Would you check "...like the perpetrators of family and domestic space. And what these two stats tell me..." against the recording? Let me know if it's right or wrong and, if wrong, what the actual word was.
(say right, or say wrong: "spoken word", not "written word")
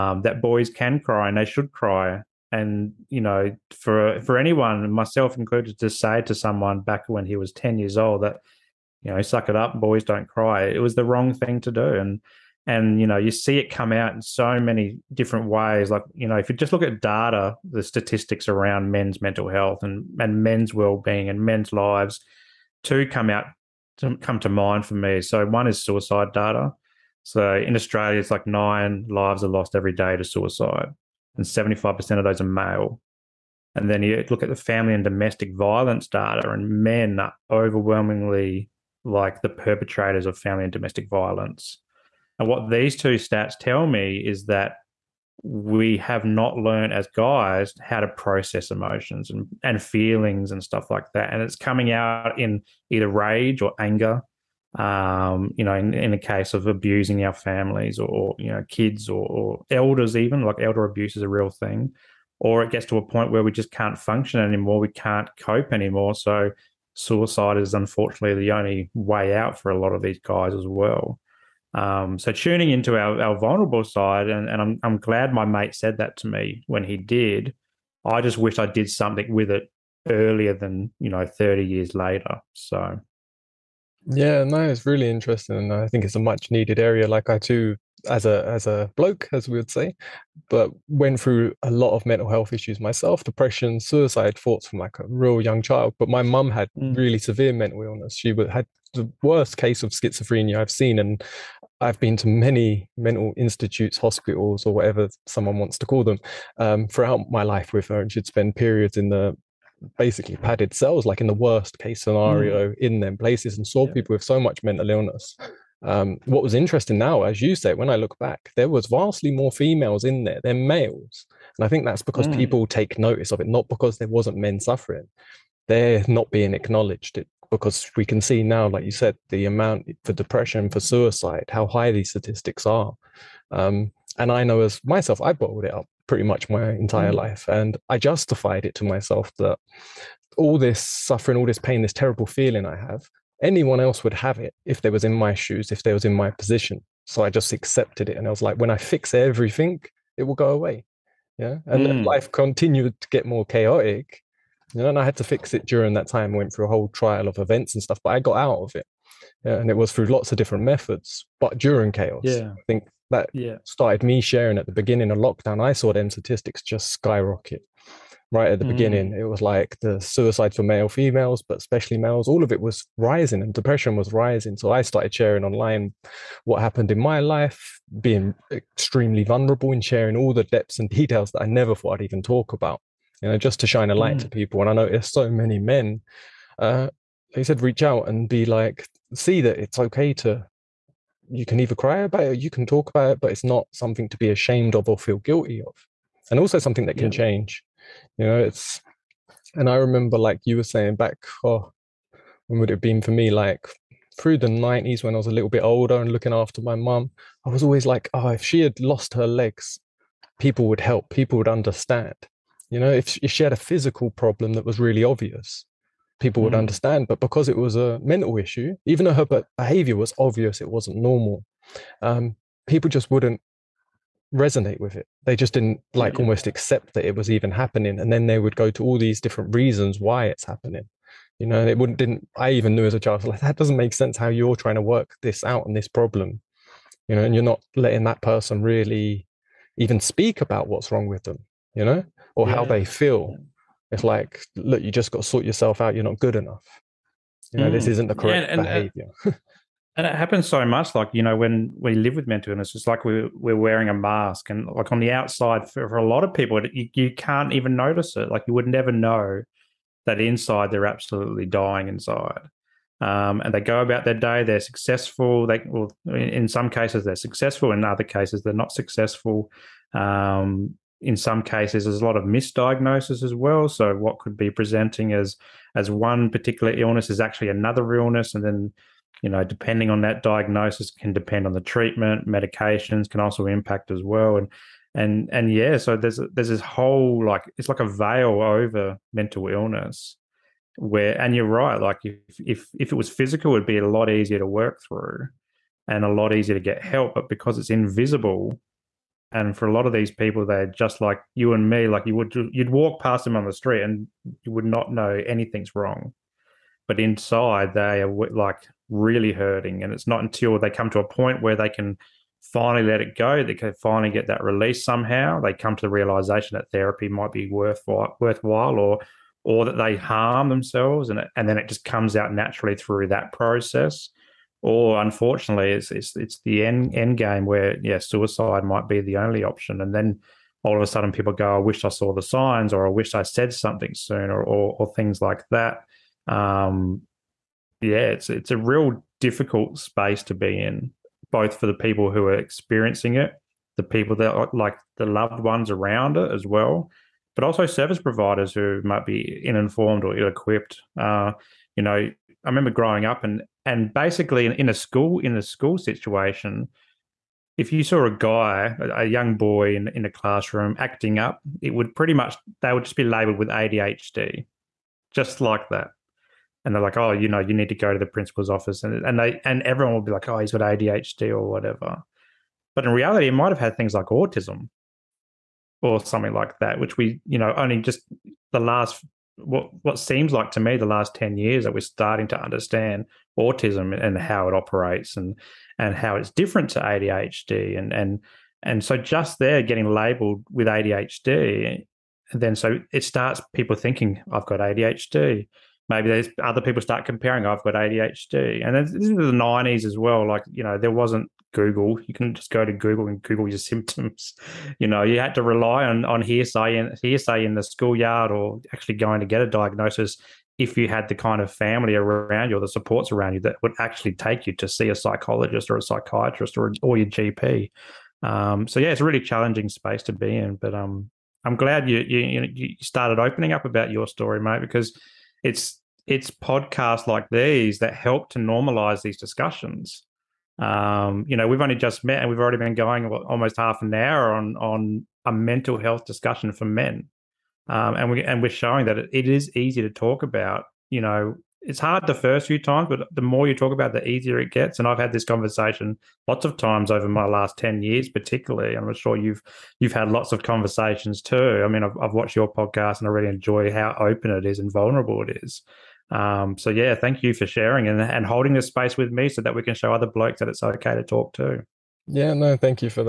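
wrong: "violence", not "space".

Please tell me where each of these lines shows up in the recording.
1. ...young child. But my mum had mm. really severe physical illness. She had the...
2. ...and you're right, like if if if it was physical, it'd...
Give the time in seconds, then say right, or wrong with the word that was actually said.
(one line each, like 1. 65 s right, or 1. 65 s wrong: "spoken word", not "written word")
1. 95 s wrong: "mental", not "physical"
2. 291 s right.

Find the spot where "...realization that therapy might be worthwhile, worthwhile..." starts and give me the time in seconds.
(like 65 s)
315 s.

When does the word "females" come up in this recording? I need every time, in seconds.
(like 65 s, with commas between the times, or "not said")
119 s, 170 s.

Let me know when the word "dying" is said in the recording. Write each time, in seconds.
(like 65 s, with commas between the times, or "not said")
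261 s.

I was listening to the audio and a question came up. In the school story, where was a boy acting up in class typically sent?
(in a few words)
The principal's office.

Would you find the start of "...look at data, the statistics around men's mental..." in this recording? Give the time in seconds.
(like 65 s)
16 s.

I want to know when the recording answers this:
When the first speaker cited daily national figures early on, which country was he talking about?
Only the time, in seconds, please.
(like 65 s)
27 s.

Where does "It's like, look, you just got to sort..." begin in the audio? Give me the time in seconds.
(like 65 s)
243 s.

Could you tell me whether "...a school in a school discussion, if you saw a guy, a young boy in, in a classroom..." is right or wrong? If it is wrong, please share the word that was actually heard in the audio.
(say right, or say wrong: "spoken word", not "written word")
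wrong: "situation", not "discussion".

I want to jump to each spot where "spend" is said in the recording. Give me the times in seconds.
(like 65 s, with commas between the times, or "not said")
108 s.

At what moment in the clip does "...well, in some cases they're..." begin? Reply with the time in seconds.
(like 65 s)
265 s.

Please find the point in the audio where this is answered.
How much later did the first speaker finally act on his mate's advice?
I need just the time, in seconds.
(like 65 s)
81 s.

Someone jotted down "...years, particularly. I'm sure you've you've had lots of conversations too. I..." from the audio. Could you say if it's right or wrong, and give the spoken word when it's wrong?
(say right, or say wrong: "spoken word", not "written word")
right.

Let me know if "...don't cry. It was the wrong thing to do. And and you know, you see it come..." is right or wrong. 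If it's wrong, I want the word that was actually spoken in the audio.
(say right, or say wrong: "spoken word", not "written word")
right.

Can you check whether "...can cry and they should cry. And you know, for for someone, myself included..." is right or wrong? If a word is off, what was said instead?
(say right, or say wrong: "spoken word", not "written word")
wrong: "anyone", not "someone".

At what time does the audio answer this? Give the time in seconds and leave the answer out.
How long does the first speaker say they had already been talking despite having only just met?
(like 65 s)
433 s.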